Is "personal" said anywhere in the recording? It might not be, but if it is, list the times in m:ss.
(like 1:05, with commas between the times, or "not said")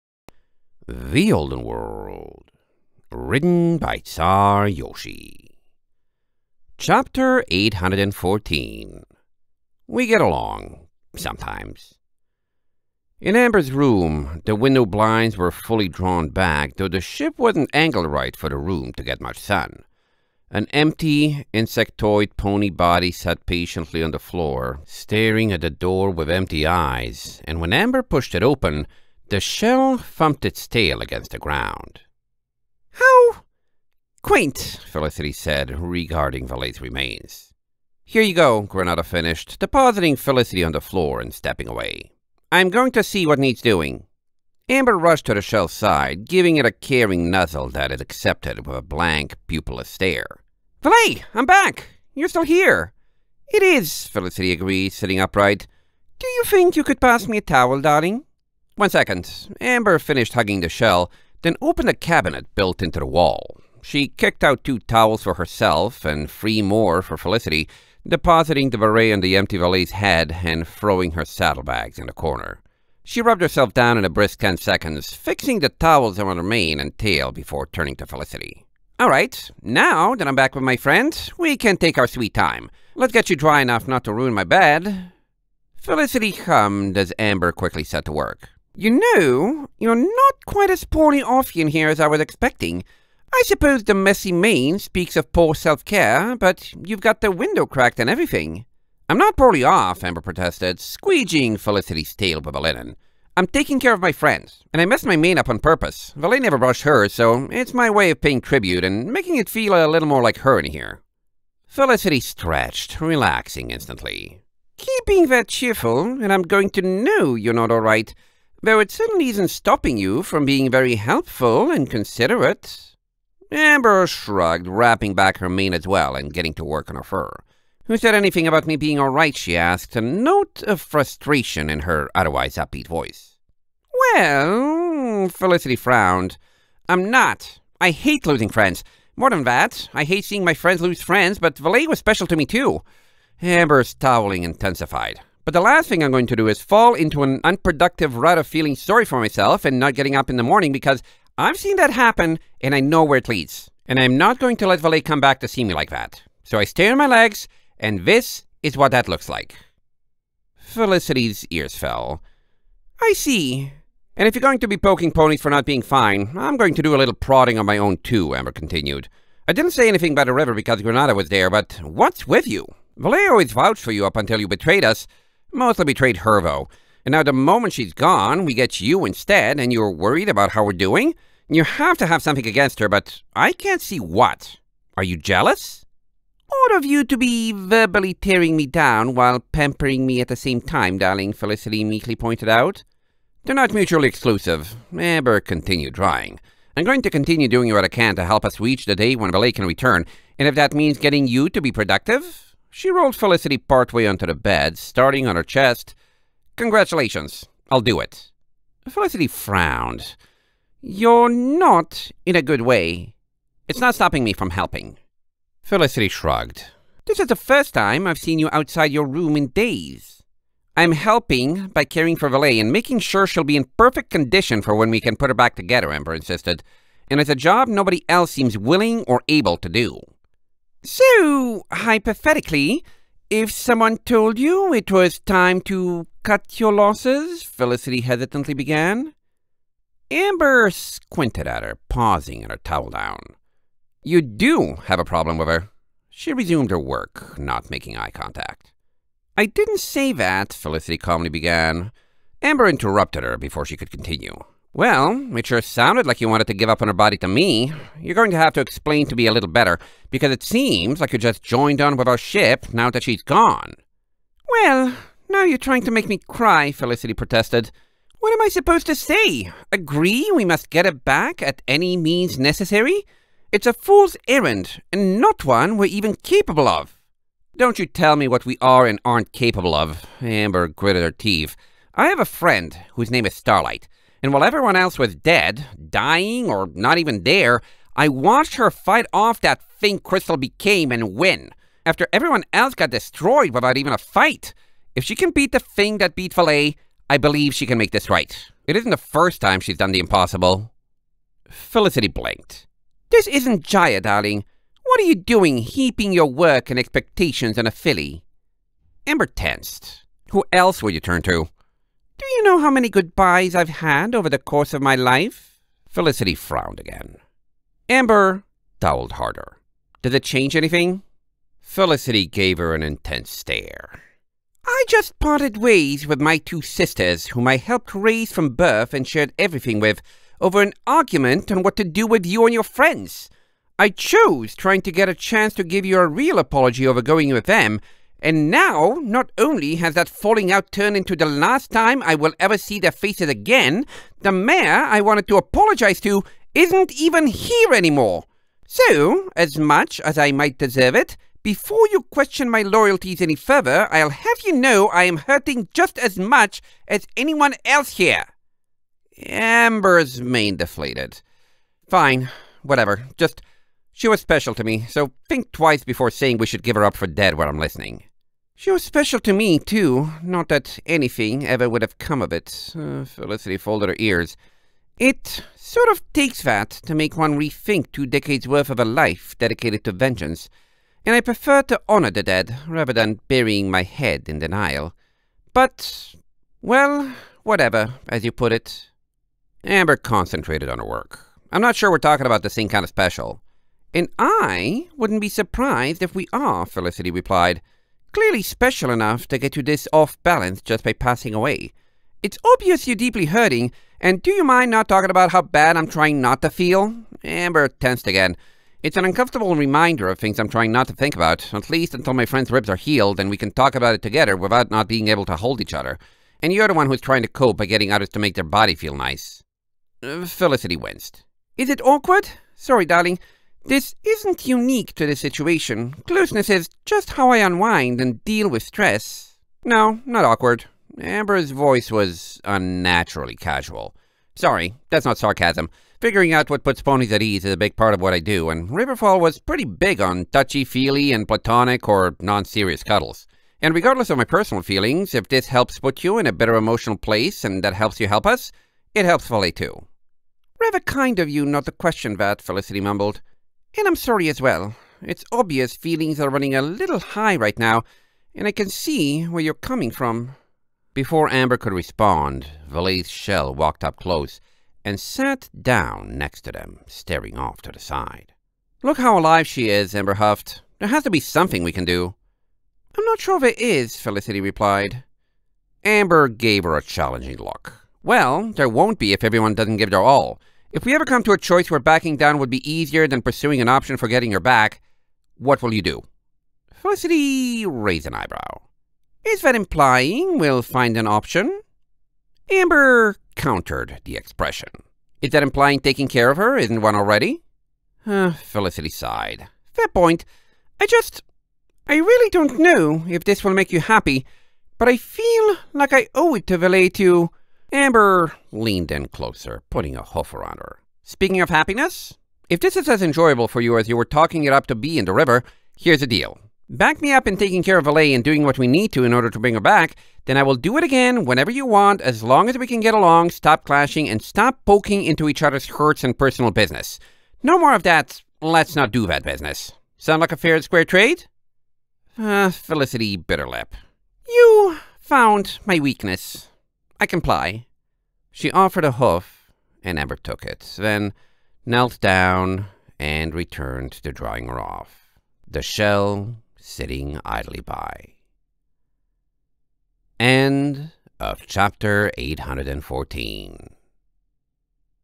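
7:24, 8:46.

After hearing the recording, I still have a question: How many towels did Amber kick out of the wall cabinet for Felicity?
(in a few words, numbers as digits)
3.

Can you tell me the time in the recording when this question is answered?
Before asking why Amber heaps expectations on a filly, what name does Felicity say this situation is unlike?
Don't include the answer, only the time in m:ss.
5:03.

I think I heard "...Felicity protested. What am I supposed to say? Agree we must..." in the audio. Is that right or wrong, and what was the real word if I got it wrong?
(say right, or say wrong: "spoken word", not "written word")
right.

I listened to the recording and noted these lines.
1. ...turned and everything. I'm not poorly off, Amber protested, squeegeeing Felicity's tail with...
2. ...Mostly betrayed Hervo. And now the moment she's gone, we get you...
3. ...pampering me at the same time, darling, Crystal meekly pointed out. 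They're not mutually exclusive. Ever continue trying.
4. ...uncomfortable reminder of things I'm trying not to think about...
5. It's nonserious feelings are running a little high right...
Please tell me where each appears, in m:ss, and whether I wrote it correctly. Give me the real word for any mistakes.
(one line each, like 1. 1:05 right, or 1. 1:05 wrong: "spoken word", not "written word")
1. 1:37 wrong: "cracked", not "turned"
2. 2:55 right
3. 3:09 wrong: "Felicity", not "Crystal"
4. 6:49 right
5. 7:35 wrong: "obvious", not "nonserious".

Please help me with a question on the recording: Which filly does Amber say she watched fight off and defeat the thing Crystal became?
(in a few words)
Starlight.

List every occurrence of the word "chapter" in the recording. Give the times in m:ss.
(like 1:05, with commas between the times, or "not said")
0:06, 9:11.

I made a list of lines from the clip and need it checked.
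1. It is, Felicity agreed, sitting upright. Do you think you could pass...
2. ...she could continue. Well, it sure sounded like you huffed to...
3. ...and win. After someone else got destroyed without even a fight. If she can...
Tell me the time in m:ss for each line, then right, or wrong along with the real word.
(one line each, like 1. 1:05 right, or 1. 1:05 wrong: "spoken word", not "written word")
1. 0:53 right
2. 4:13 wrong: "wanted", not "huffed"
3. 4:50 wrong: "everyone", not "someone".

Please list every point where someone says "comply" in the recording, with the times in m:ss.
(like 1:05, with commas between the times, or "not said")
8:57.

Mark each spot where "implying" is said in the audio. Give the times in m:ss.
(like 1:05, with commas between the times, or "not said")
8:09, 8:15.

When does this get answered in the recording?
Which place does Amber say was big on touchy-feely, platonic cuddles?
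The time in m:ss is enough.
7:18.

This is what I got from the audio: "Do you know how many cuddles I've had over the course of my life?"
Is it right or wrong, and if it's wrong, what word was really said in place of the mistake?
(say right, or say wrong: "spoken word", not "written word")
wrong: "goodbyes", not "cuddles".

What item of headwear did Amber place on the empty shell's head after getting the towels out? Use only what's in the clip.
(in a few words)
beret.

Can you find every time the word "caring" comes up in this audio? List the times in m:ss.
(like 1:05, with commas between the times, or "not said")
0:46, 3:41.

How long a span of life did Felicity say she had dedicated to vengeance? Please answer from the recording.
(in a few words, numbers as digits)
two decades.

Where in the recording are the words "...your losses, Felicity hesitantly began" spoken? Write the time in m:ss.
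3:56.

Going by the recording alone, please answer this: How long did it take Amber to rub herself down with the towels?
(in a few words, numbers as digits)
10 seconds.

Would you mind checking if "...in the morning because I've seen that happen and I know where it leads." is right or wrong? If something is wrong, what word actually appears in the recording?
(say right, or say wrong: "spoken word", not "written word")
right.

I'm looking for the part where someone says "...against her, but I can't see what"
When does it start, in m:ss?
3:02.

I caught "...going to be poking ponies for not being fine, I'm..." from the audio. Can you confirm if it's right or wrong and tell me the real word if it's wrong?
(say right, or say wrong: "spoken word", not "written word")
right.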